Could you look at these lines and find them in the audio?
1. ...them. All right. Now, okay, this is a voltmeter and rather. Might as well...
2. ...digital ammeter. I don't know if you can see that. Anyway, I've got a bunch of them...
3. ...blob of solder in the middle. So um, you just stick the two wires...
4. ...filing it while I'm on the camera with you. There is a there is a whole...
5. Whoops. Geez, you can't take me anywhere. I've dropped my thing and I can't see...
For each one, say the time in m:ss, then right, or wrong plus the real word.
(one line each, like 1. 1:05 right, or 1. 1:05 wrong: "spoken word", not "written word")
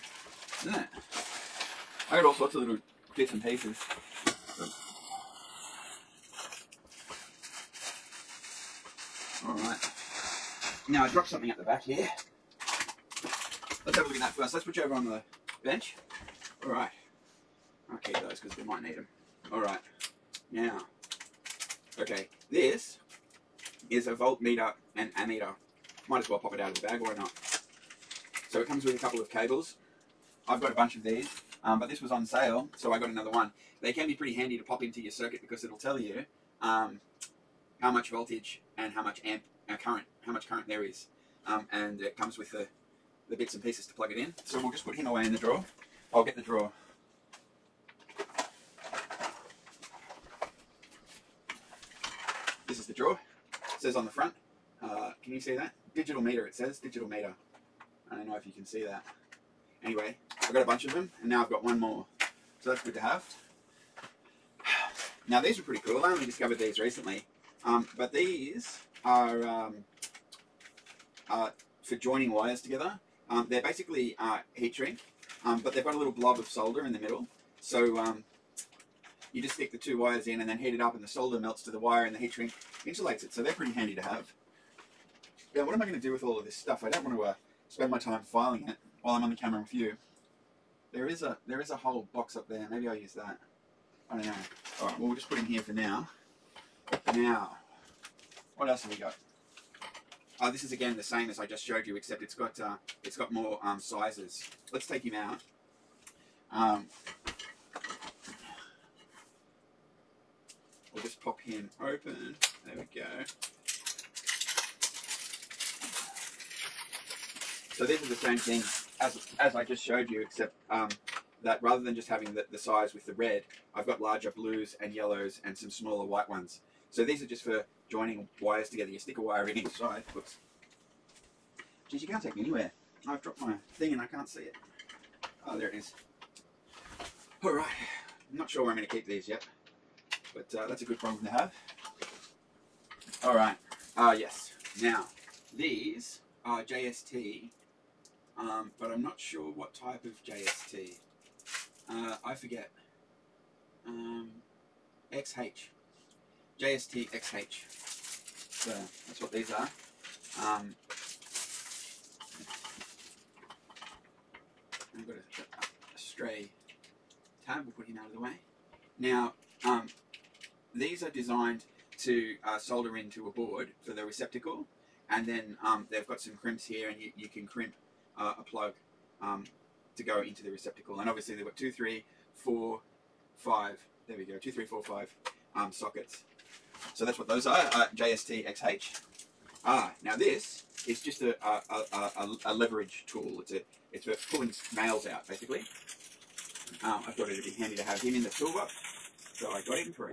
1. 0:18 wrong: "ammeter", not "rather"
2. 0:56 wrong: "meter", not "ammeter"
3. 1:16 right
4. 1:28 right
5. 2:10 right.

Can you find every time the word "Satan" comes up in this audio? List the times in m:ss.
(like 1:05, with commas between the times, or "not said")
not said.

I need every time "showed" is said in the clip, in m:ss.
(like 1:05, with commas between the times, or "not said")
1:41, 1:59.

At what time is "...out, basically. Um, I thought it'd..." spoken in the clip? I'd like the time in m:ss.
3:15.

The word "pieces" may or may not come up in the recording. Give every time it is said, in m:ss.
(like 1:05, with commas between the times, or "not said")
0:03, 0:43.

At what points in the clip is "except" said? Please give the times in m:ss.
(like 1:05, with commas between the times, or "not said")
1:41, 2:00.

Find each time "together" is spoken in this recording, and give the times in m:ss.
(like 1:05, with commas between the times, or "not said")
1:12, 2:08.